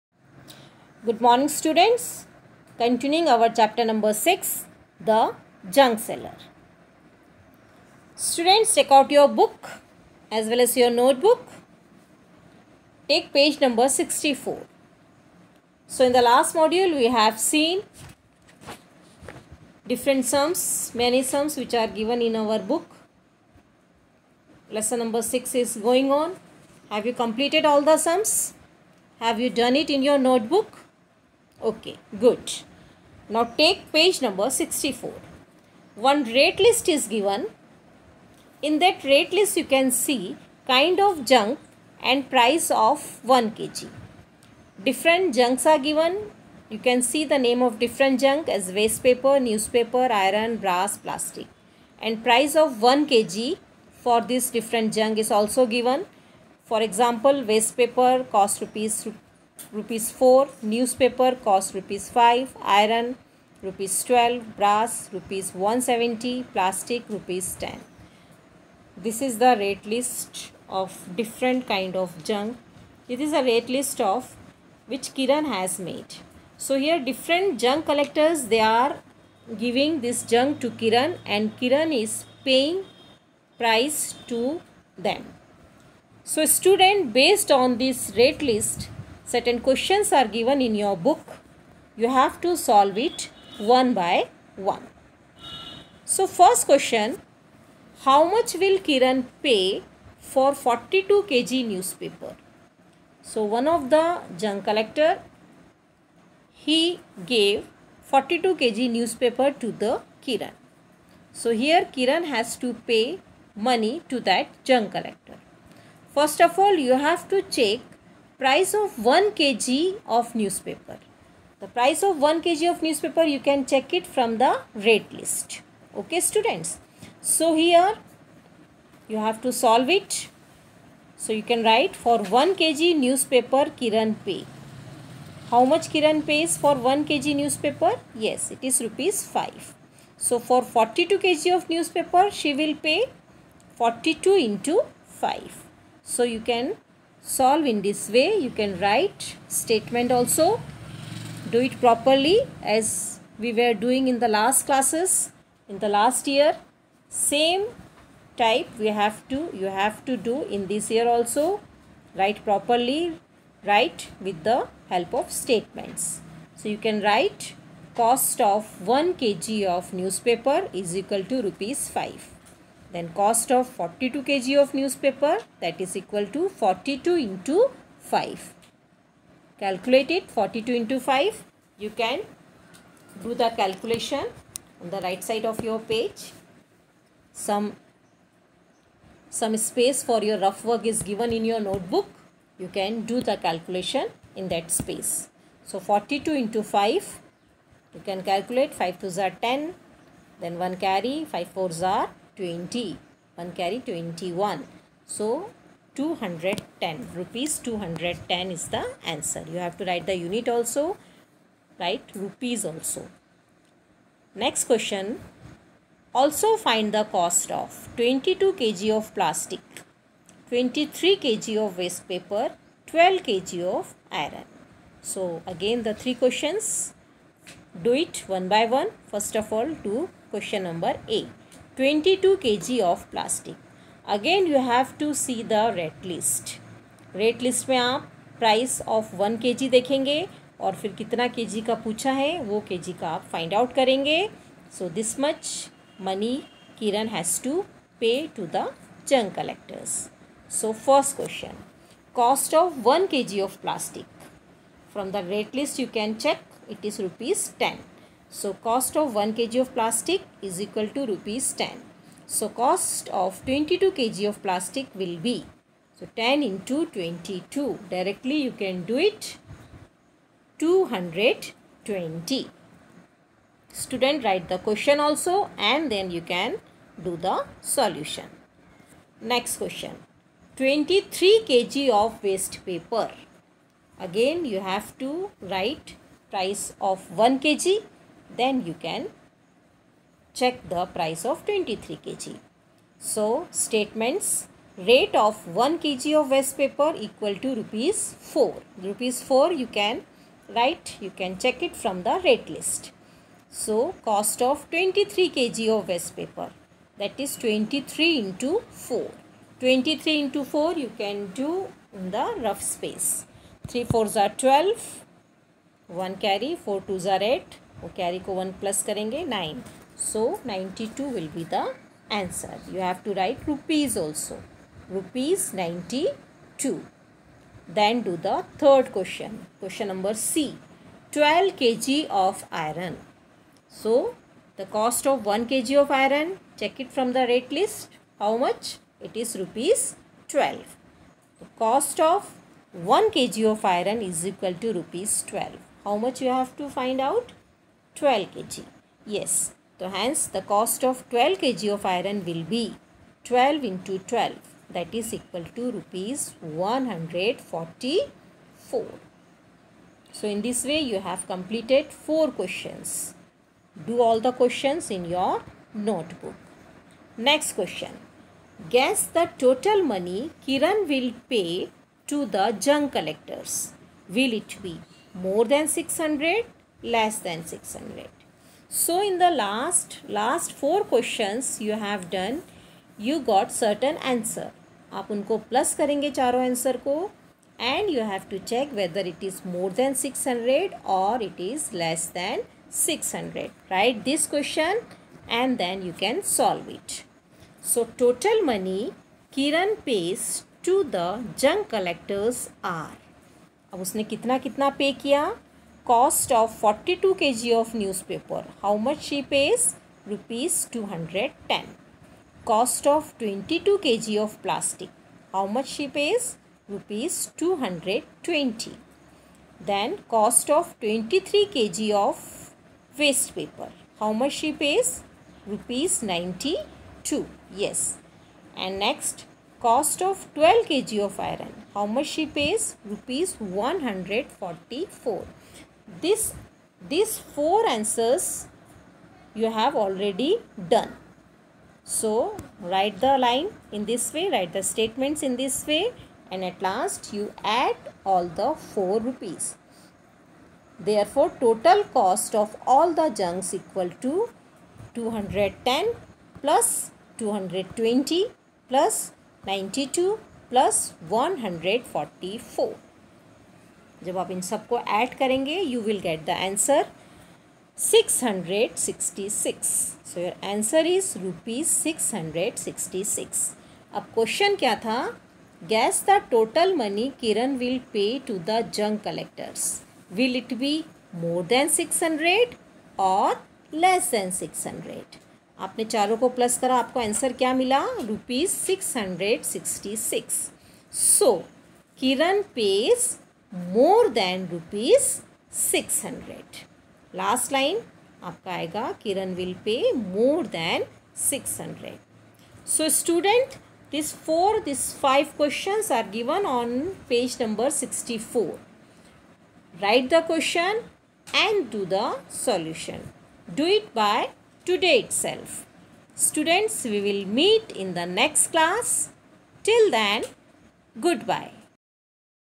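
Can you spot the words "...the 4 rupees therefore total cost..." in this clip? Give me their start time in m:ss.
7:28.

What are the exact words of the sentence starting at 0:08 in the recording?
Students, take out your book as well as your notebook.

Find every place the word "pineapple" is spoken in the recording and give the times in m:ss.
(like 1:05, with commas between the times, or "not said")
not said.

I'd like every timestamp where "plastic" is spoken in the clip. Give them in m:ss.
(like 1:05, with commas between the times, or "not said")
0:50, 1:06, 3:39, 3:53, 4:13, 4:19, 4:24, 6:54.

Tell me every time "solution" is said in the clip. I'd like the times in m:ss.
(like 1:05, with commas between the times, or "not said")
4:37, 8:32.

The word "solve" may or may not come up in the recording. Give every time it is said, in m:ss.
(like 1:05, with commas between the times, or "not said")
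1:32, 2:09, 2:27, 6:36.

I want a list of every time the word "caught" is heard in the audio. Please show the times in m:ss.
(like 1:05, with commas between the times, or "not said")
not said.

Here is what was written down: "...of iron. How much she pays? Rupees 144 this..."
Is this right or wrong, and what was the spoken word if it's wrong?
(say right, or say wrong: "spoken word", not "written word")
right.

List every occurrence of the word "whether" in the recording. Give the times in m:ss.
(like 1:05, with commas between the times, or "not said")
6:28.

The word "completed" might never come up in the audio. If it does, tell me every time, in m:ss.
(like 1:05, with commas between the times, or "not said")
0:27, 6:01.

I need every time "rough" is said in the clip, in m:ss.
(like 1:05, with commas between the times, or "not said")
3:10, 5:12.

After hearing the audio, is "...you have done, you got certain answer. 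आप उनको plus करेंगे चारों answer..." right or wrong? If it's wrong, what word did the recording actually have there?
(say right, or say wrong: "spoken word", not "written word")
right.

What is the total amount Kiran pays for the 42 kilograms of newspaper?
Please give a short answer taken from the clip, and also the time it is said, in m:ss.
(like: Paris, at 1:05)
Rs 210, at 3:25.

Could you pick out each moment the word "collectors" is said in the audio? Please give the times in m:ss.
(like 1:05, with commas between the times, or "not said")
1:17, 1:44, 1:54, 4:09, 6:12, 6:41.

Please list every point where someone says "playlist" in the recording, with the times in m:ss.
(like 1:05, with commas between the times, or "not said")
not said.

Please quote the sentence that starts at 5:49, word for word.
Yes, so hence the cost of 12 kg of iron will be 12 into 12 that is equal to rupees 144.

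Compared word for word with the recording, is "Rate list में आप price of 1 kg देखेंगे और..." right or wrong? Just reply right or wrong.
right.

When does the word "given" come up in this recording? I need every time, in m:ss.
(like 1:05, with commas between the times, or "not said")
0:21, 0:37, 0:45, 0:55, 1:30, 3:11, 8:26.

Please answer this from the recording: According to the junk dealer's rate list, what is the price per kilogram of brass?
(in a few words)
Rs 170.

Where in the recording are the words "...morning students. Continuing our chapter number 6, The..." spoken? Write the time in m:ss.
0:01.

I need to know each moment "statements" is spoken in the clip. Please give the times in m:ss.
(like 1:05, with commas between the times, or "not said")
2:29, 2:45, 4:53, 7:24.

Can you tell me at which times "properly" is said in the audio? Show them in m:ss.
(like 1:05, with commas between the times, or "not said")
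2:31, 2:42.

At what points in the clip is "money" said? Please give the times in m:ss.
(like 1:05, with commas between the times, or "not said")
1:53, 4:06, 6:09, 6:38.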